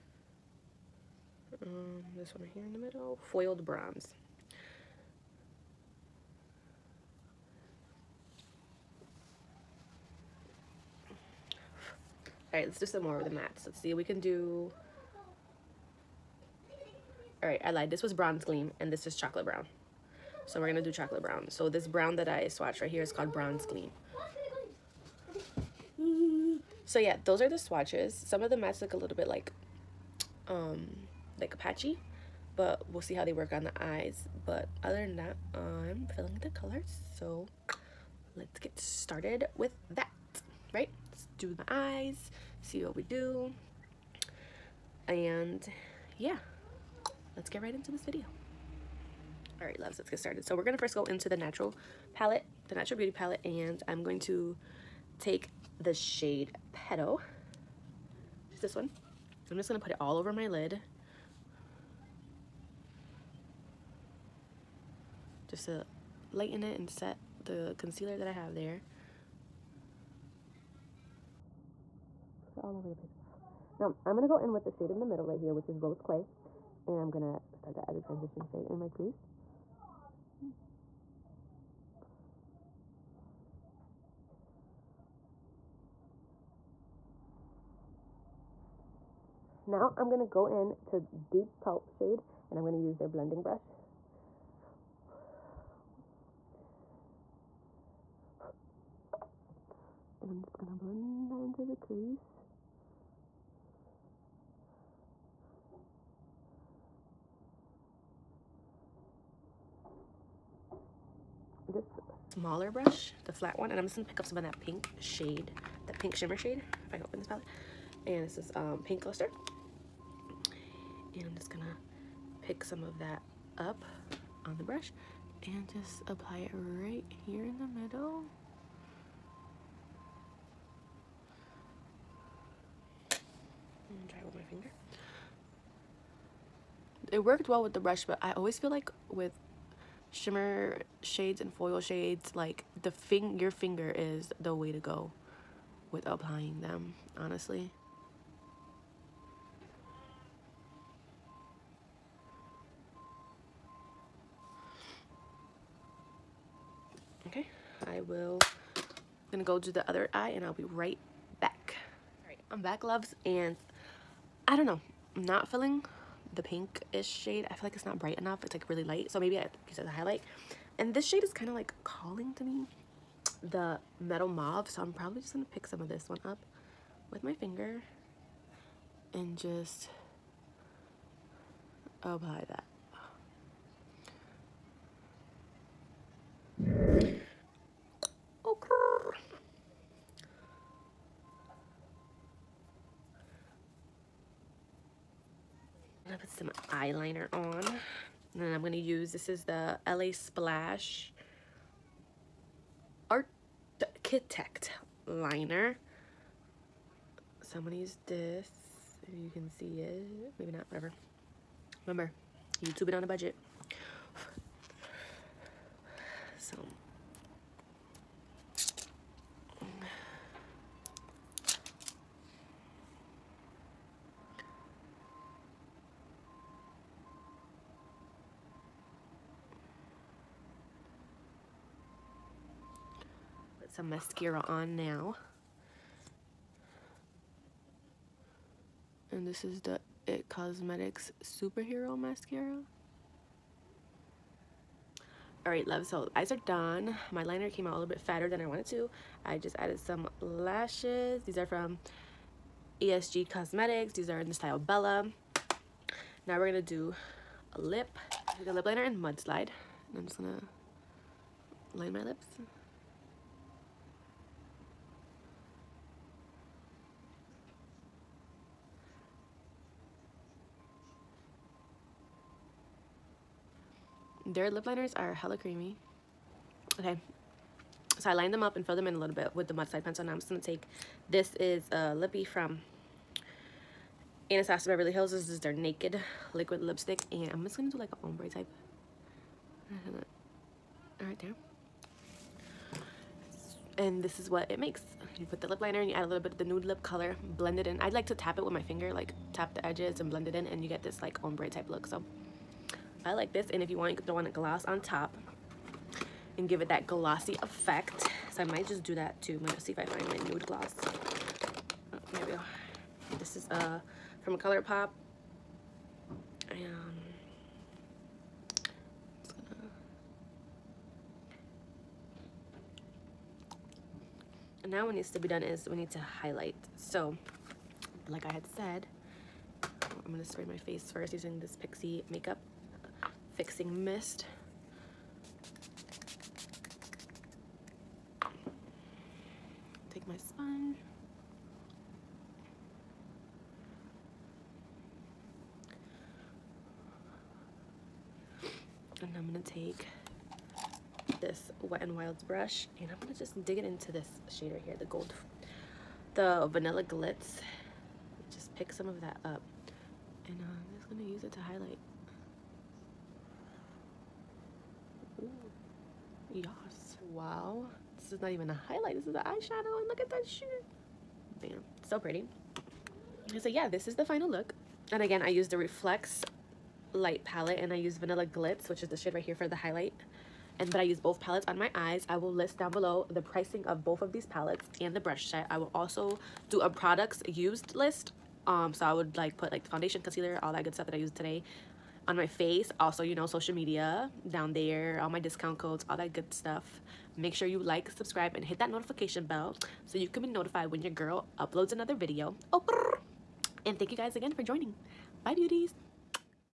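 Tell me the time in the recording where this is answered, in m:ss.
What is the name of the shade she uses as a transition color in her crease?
1:15.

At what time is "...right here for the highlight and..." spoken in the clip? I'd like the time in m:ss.
6:19.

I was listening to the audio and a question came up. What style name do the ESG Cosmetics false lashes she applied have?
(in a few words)
Bella.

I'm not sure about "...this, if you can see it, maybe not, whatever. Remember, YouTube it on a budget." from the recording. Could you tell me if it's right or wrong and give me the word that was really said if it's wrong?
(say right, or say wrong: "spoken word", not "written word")
right.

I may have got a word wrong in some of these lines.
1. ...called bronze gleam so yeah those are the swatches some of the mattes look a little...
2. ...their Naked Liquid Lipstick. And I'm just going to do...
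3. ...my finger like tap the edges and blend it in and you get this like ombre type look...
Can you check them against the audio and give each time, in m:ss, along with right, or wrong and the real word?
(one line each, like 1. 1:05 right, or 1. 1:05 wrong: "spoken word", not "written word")
1. 0:23 right
2. 4:45 right
3. 4:58 right.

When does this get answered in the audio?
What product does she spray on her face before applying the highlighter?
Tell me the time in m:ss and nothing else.
5:31.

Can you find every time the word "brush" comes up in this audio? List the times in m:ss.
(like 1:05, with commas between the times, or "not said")
1:33, 1:52, 2:04, 2:17, 5:52, 6:24.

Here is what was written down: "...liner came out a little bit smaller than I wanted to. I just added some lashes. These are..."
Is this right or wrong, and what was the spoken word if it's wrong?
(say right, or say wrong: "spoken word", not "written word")
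wrong: "fatter", not "smaller".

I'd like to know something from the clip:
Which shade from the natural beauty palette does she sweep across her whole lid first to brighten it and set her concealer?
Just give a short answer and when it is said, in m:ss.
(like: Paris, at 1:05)
Petal, at 0:56.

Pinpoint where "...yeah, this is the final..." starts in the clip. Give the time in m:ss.
6:13.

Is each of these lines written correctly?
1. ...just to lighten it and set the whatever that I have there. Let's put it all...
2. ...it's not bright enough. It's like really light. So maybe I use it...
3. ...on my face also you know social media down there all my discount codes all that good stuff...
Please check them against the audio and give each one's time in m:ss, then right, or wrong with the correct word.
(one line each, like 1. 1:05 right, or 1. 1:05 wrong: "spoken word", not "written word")
1. 1:05 wrong: "concealer", not "whatever"
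2. 2:47 right
3. 6:32 right.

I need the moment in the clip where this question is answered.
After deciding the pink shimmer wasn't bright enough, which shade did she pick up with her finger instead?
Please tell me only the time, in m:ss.
2:53.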